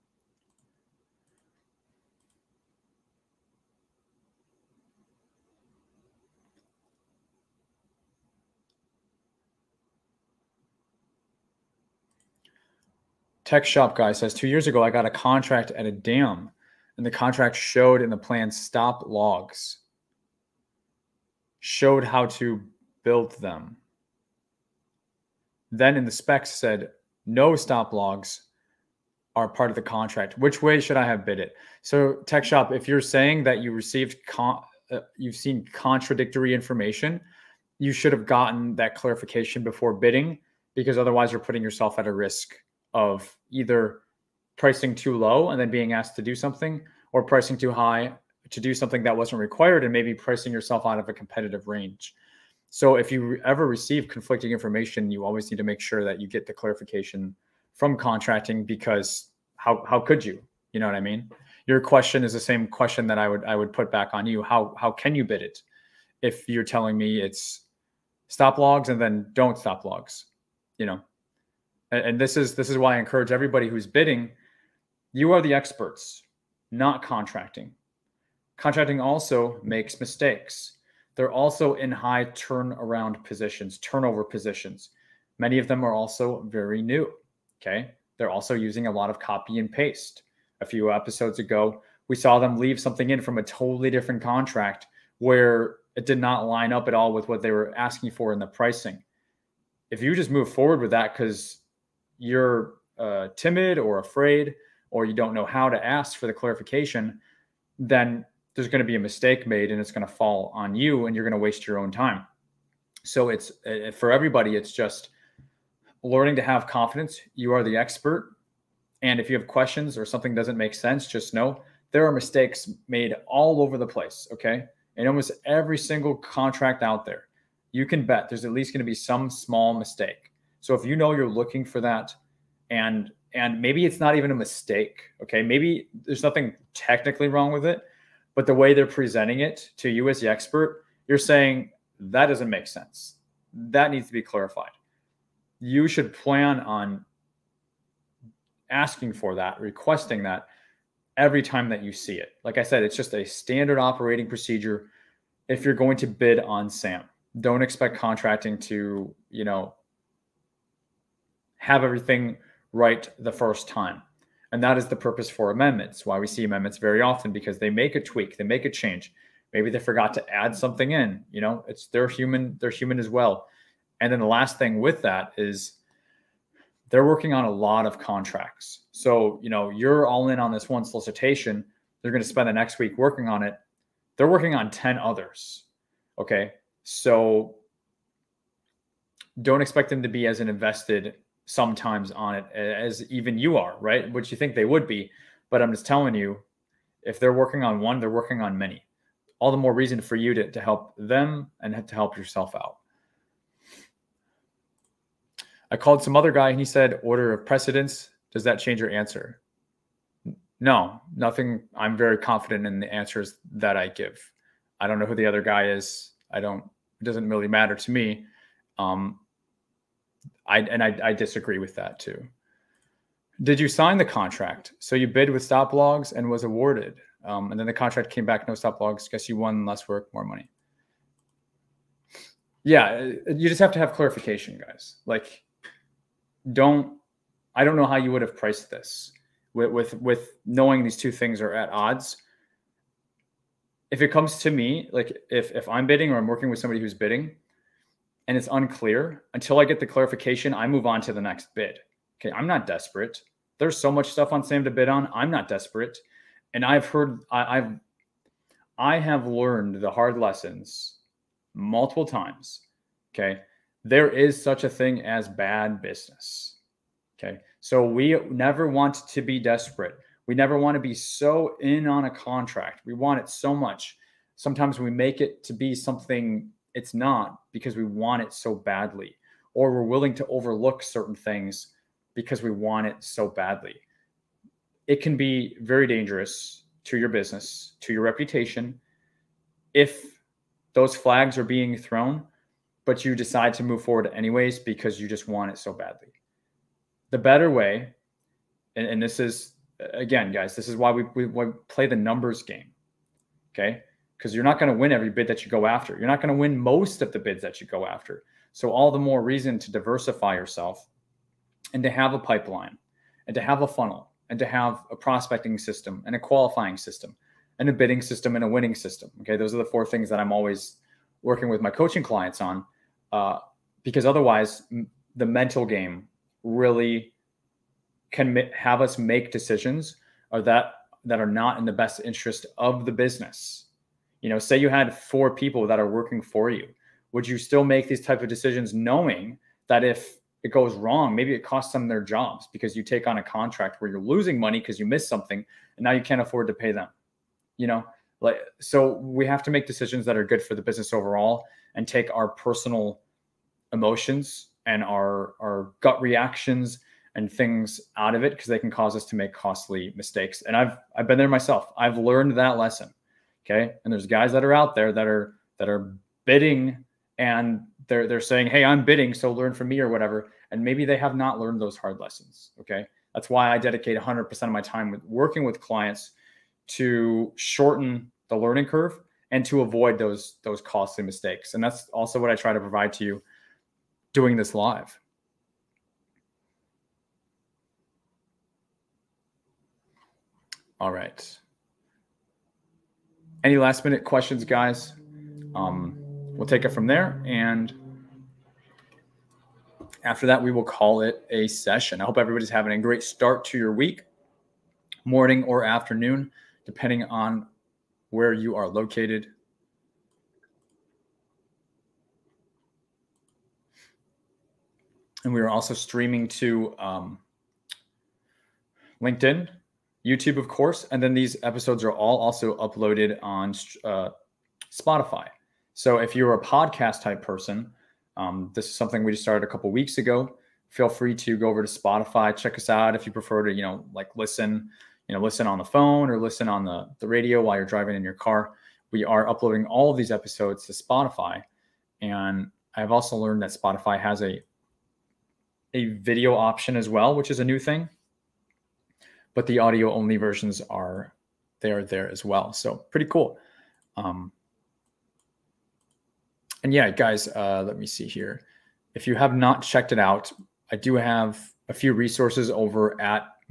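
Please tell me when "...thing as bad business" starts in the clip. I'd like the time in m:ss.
4:24.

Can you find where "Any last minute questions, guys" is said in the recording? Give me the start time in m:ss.
6:33.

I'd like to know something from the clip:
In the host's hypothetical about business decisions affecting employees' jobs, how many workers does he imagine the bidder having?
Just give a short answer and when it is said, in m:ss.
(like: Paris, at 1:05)
4, at 5:34.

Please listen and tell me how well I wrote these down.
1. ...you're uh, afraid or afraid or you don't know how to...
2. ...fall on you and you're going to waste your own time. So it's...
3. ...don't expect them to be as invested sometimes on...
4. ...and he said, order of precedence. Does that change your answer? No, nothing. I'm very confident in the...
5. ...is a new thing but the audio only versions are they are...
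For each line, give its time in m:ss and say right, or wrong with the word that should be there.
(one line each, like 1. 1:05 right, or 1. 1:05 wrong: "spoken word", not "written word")
1. 1:42 wrong: "timid", not "afraid"
2. 1:50 right
3. 3:09 right
4. 3:26 right
5. 7:27 right.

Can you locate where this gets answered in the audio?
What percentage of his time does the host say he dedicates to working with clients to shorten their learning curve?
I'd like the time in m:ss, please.
6:13.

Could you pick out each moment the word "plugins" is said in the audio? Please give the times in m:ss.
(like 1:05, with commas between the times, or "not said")
not said.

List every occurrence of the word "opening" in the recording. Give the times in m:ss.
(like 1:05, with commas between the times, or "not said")
not said.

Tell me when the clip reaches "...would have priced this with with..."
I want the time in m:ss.
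3:58.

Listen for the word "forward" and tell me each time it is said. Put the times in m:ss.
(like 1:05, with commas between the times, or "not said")
1:40, 4:53.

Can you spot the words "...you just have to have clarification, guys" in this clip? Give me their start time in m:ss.
3:53.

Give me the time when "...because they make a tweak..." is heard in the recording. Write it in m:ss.
2:47.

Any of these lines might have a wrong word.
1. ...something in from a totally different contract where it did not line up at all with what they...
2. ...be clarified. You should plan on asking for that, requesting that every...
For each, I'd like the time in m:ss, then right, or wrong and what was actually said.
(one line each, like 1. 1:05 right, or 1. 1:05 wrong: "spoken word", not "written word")
1. 1:32 right
2. 2:24 right.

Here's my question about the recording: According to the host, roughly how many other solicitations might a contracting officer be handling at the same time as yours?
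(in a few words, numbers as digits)
10.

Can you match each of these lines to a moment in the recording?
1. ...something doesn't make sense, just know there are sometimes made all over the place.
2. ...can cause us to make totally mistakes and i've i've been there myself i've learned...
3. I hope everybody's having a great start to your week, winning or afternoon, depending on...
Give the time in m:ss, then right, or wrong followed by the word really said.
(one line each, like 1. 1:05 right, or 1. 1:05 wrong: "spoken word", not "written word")
1. 2:00 wrong: "mistakes", not "sometimes"
2. 5:58 wrong: "costly", not "totally"
3. 6:42 wrong: "morning", not "winning".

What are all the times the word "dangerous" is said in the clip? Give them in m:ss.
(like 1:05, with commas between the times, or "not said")
4:45.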